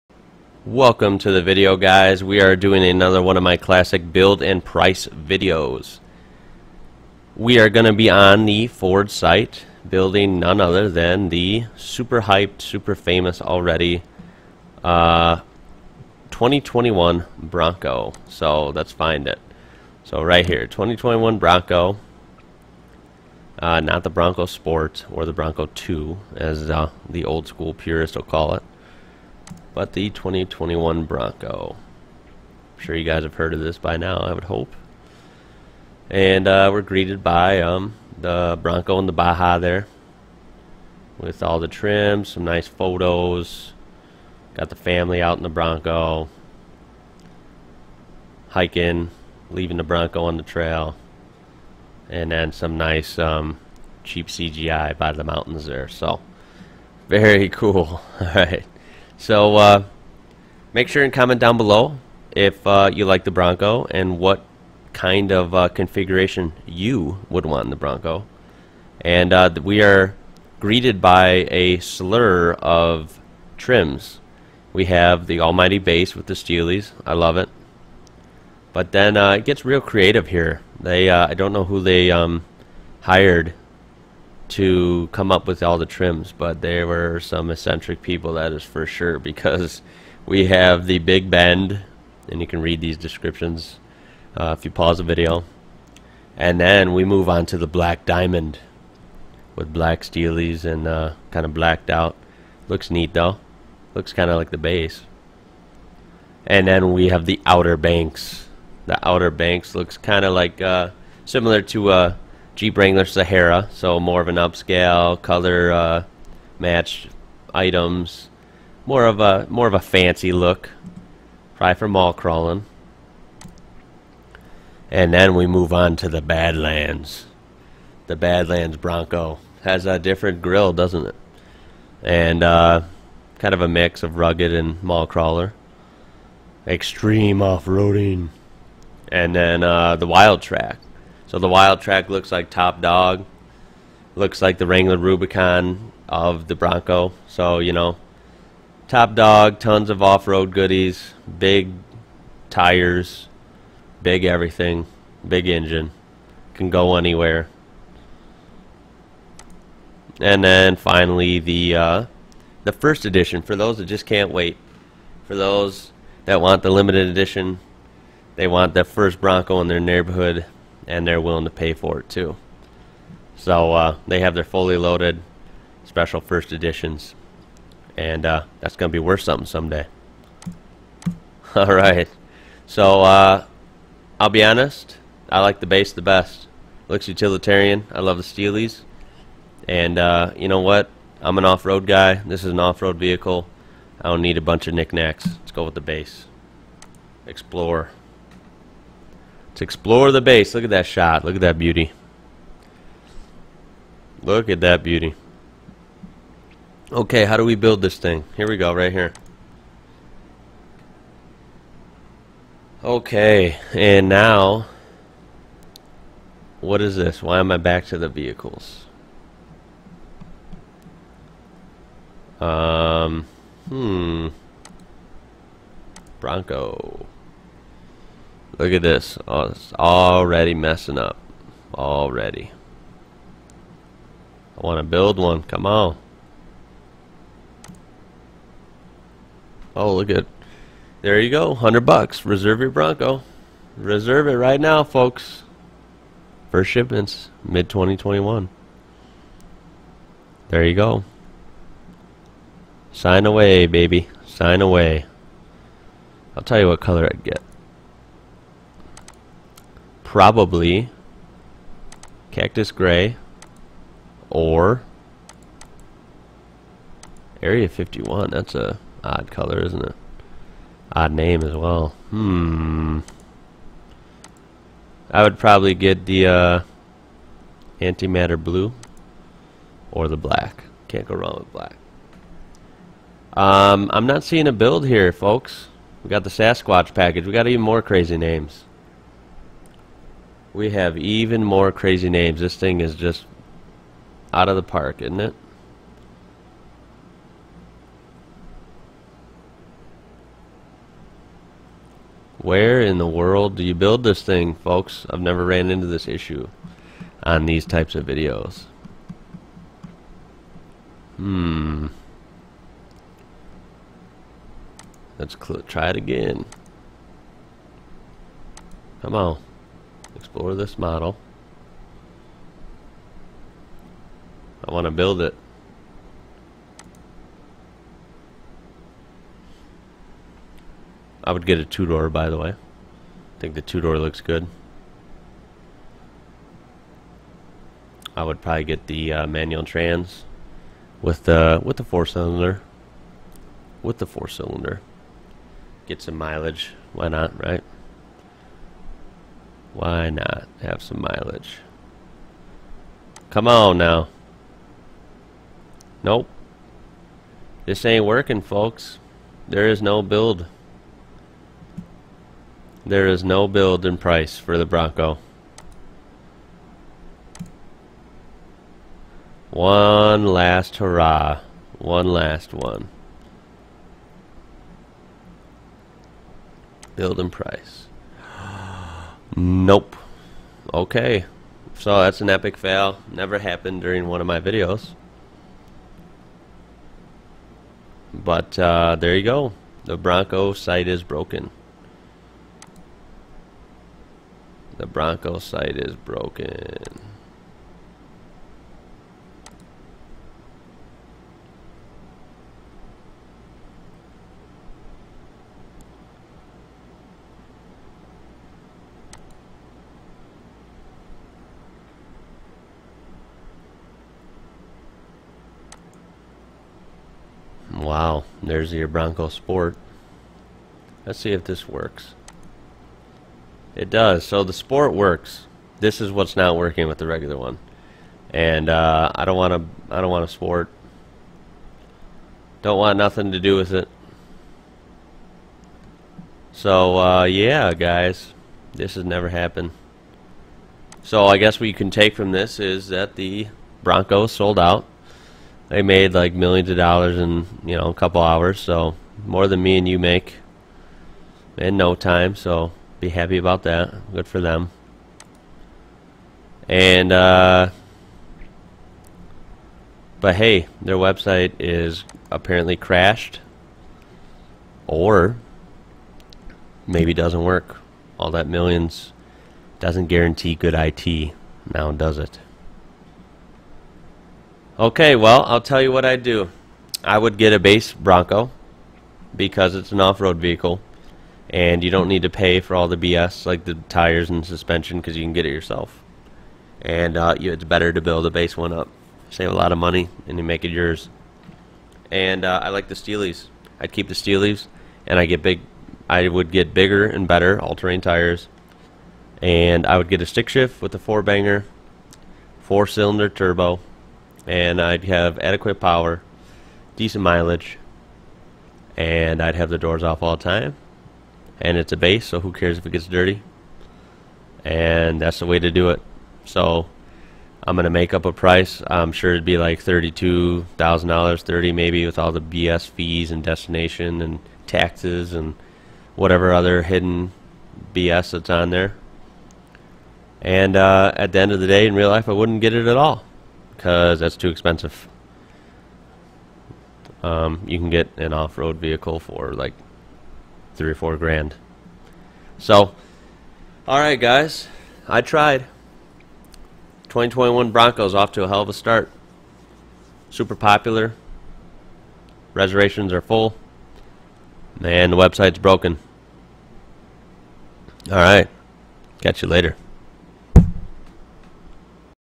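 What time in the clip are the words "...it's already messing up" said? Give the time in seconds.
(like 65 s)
229 s.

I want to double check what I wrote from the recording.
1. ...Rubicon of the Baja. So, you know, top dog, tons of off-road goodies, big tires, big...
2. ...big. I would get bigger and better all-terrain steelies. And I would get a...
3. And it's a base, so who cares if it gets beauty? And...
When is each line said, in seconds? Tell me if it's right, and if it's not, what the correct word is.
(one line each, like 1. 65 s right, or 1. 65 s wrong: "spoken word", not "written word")
1. 144 s wrong: "Bronco", not "Baja"
2. 495 s wrong: "tires", not "steelies"
3. 511 s wrong: "dirty", not "beauty".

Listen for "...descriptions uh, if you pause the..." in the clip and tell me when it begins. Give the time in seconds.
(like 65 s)
92 s.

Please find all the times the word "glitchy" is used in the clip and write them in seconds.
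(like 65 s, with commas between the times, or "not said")
not said.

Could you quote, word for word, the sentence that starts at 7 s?
We are going to be on the Ford site building none other than the super hyped, super famous already uh, 2021 Bronco.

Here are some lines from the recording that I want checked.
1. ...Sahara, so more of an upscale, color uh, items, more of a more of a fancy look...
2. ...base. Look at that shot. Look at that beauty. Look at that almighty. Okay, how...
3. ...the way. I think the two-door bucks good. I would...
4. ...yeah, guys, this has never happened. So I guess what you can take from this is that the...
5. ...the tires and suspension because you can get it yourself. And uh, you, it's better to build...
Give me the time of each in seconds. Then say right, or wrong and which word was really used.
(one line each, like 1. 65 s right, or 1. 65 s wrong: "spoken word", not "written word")
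1. 113 s right
2. 200 s wrong: "beauty", not "almighty"
3. 332 s wrong: "looks", not "bucks"
4. 437 s right
5. 483 s right.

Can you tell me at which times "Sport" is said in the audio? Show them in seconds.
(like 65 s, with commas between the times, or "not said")
24 s, 419 s, 424 s, 430 s.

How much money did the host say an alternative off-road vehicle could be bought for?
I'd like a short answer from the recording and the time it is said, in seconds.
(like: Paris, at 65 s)
3 or 4 grand, at 540 s.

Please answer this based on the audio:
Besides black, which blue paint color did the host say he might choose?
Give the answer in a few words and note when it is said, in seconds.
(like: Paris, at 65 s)
Antimatter blue, at 277 s.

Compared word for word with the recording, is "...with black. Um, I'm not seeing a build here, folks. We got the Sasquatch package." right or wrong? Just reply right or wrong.
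right.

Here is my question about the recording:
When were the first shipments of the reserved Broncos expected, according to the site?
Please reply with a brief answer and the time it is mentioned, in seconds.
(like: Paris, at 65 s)
Mid 2021, at 247 s.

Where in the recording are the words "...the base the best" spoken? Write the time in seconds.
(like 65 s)
185 s.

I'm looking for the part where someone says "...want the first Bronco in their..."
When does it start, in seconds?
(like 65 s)
168 s.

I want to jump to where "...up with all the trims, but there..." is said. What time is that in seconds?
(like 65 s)
85 s.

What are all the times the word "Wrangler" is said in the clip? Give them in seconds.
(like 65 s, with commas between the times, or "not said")
112 s, 144 s.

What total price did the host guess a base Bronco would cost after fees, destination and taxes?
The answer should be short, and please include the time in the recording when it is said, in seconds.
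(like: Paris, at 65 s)
$32,000, at 519 s.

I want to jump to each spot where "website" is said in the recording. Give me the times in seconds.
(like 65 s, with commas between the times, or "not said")
460 s, 555 s.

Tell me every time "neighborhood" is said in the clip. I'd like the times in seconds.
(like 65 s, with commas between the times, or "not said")
169 s.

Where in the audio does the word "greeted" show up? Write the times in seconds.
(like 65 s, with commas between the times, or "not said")
36 s, 70 s.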